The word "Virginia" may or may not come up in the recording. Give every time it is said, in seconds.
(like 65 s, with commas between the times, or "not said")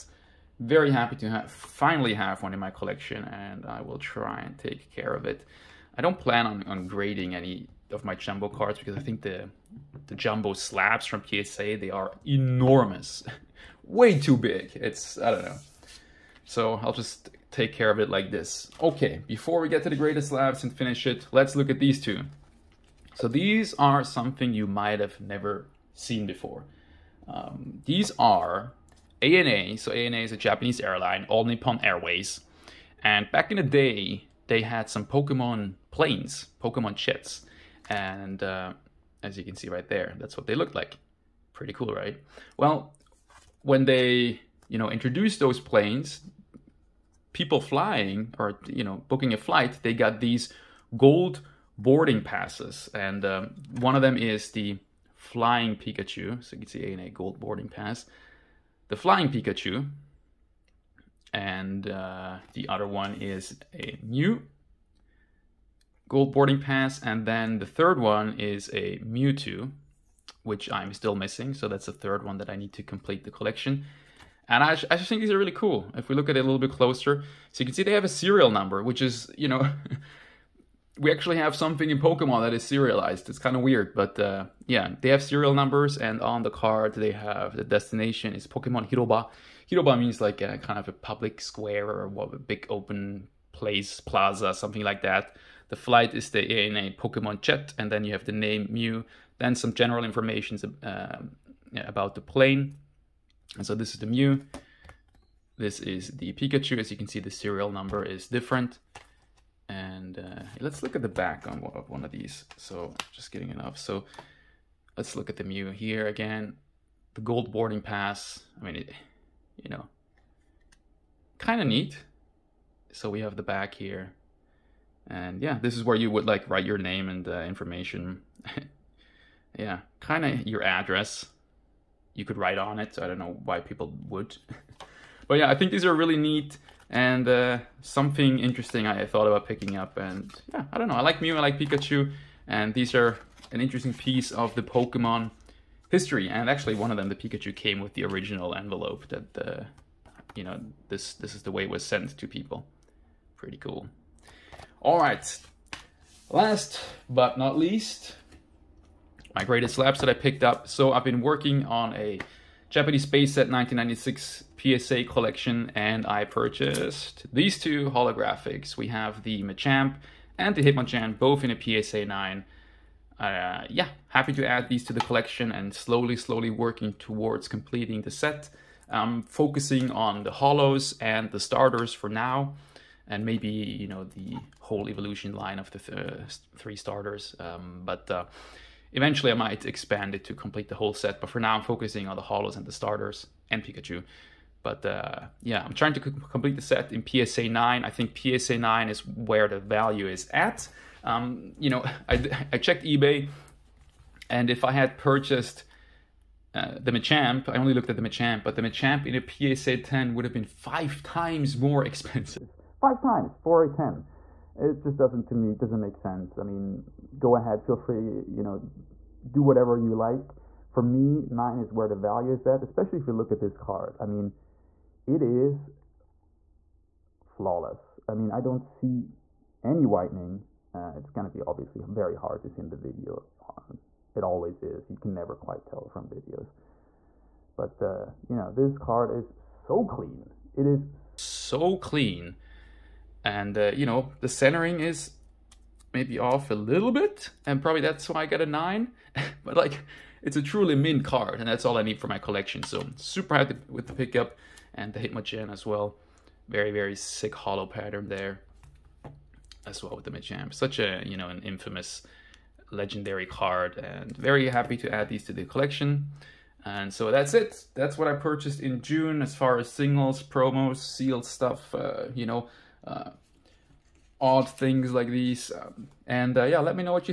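not said.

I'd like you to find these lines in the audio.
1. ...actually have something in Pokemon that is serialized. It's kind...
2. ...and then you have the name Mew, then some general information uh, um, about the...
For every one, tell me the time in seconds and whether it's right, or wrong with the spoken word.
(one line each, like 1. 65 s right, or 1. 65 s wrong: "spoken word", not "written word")
1. 81 s right
2. 97 s right.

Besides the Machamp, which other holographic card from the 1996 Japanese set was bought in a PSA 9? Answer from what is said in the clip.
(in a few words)
Hitmonchan.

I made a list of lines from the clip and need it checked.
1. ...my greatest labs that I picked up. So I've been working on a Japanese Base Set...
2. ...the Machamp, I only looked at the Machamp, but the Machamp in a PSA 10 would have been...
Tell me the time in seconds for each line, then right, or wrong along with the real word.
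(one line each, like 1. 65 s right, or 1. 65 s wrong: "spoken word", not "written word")
1. 159 s right
2. 206 s right.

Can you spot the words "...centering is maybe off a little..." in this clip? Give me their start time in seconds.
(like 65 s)
244 s.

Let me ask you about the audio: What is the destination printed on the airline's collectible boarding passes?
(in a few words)
Pokemon Hiroba.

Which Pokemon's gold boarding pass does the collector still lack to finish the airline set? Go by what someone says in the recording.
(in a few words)
Mewtwo.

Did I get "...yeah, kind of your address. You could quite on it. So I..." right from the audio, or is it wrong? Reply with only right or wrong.
wrong.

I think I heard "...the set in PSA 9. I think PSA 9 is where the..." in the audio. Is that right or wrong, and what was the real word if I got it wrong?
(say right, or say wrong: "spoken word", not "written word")
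right.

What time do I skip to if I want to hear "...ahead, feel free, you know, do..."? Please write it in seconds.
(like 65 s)
217 s.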